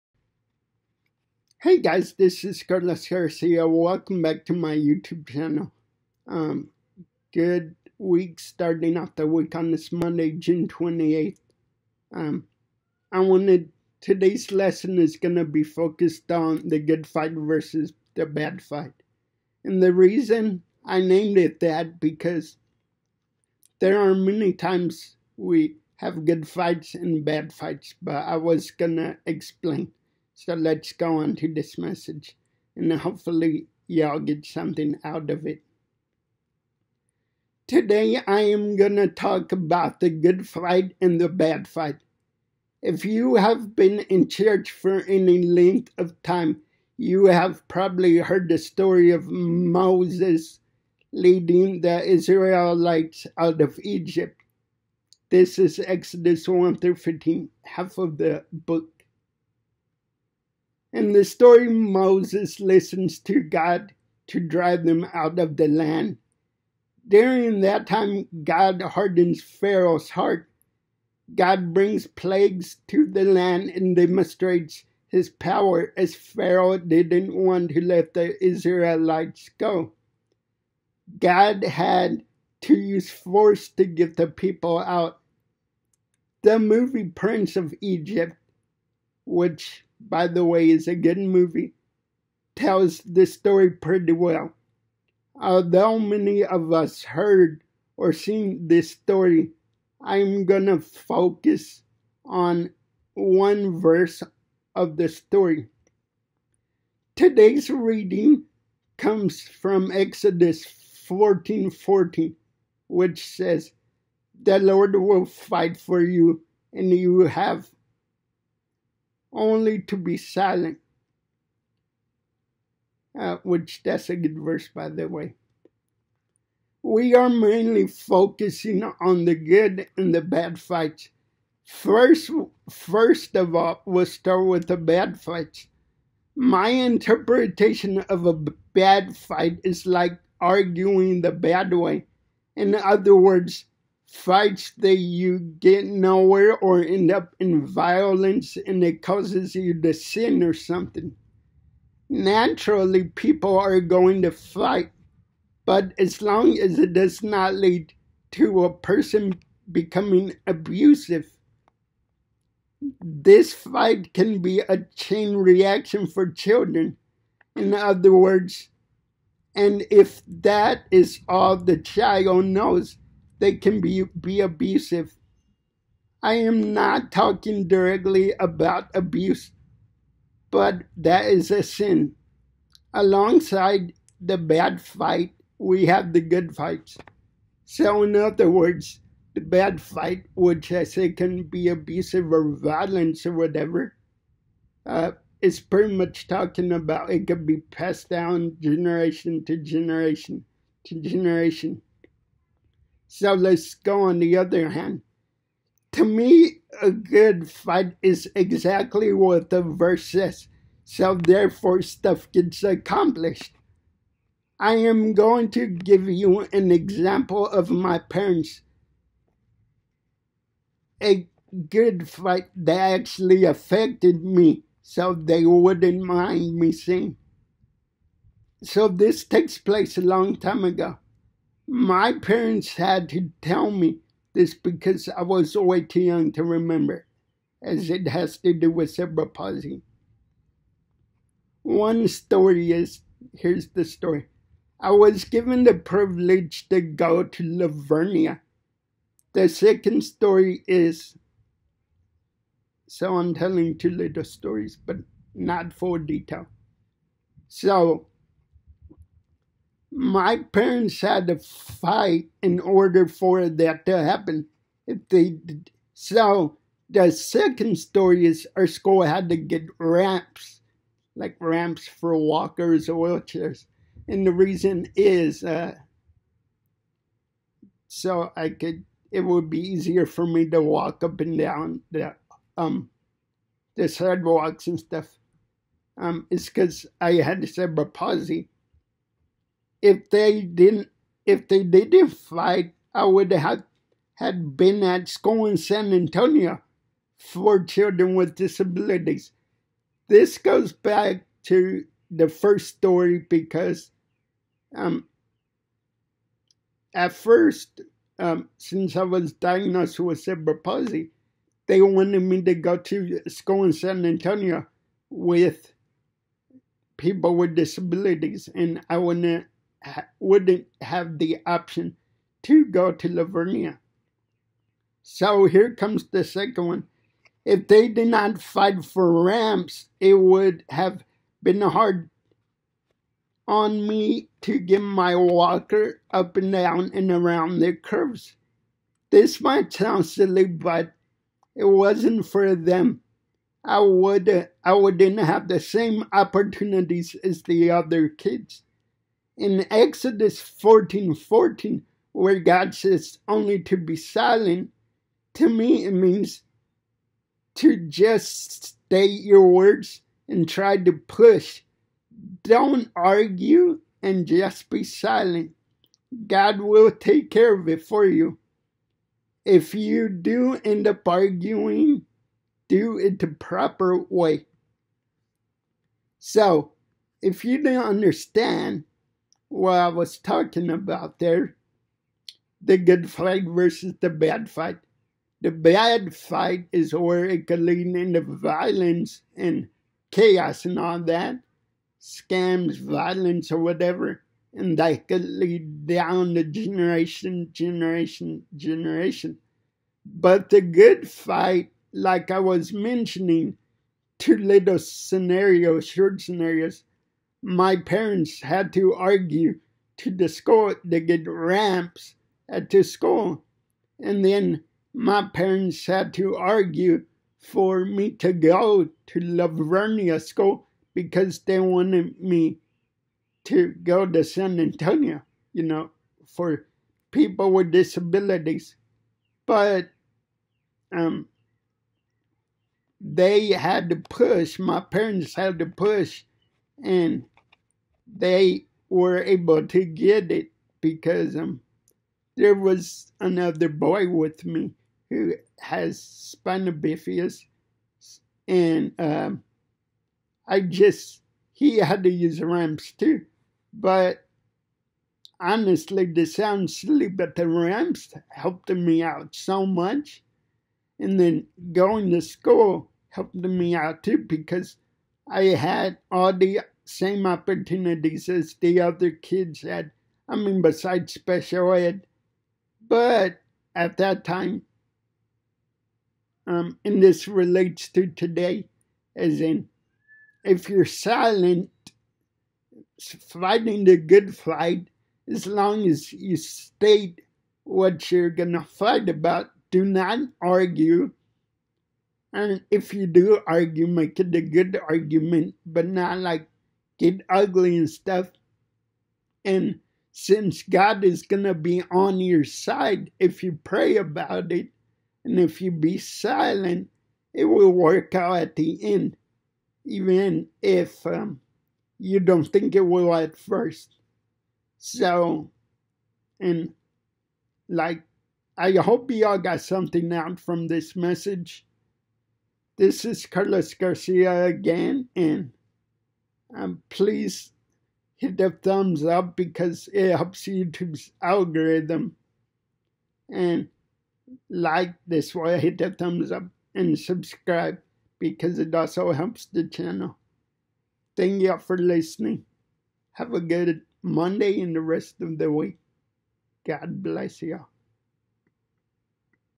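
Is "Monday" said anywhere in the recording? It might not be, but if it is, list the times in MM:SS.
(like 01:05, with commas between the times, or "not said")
00:09, 09:04.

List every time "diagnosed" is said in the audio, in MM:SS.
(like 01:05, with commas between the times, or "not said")
05:09.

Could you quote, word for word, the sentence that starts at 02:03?
Uh, which that's a good verse, by the way.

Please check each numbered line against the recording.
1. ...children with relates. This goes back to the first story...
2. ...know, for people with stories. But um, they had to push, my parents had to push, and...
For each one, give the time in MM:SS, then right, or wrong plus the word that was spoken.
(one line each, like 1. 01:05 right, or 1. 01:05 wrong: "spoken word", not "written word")
1. 04:57 wrong: "disabilities", not "relates"
2. 07:05 wrong: "disabilities", not "stories".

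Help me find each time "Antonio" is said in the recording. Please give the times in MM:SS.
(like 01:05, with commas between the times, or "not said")
04:55, 05:14, 07:04.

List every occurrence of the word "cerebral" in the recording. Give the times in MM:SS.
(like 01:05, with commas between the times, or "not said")
03:58, 04:47, 05:10.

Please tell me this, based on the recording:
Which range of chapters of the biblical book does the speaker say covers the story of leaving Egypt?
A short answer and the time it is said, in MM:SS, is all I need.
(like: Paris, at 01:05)
Exodus 1 through 15, at 00:55.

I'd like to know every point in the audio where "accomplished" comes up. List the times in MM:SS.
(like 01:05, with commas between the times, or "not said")
03:32.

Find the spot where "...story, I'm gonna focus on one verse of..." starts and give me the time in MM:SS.
01:38.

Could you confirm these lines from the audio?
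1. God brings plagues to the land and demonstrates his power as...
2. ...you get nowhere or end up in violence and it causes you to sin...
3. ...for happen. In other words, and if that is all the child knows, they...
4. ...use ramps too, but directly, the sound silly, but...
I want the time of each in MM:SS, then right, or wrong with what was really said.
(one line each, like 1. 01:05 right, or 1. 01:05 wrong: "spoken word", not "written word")
1. 01:11 right
2. 02:24 right
3. 02:46 wrong: "children", not "happen"
4. 07:32 wrong: "honestly", not "directly".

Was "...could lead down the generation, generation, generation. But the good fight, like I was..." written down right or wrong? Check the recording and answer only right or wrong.
right.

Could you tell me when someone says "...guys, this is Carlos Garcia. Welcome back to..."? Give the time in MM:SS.
00:01.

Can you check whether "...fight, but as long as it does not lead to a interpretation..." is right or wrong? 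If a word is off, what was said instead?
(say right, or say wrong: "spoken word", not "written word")
wrong: "person", not "interpretation".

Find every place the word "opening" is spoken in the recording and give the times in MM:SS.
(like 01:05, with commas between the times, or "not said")
not said.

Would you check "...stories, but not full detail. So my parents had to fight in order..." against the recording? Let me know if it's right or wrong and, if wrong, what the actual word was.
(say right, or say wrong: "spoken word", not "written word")
right.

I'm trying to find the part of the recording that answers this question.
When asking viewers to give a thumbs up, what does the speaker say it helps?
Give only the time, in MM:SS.
08:50.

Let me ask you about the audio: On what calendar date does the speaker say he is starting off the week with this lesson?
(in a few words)
June 28.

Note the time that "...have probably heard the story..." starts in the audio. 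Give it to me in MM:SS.
00:47.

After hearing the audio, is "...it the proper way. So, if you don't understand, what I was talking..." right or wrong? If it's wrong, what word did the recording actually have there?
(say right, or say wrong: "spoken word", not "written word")
right.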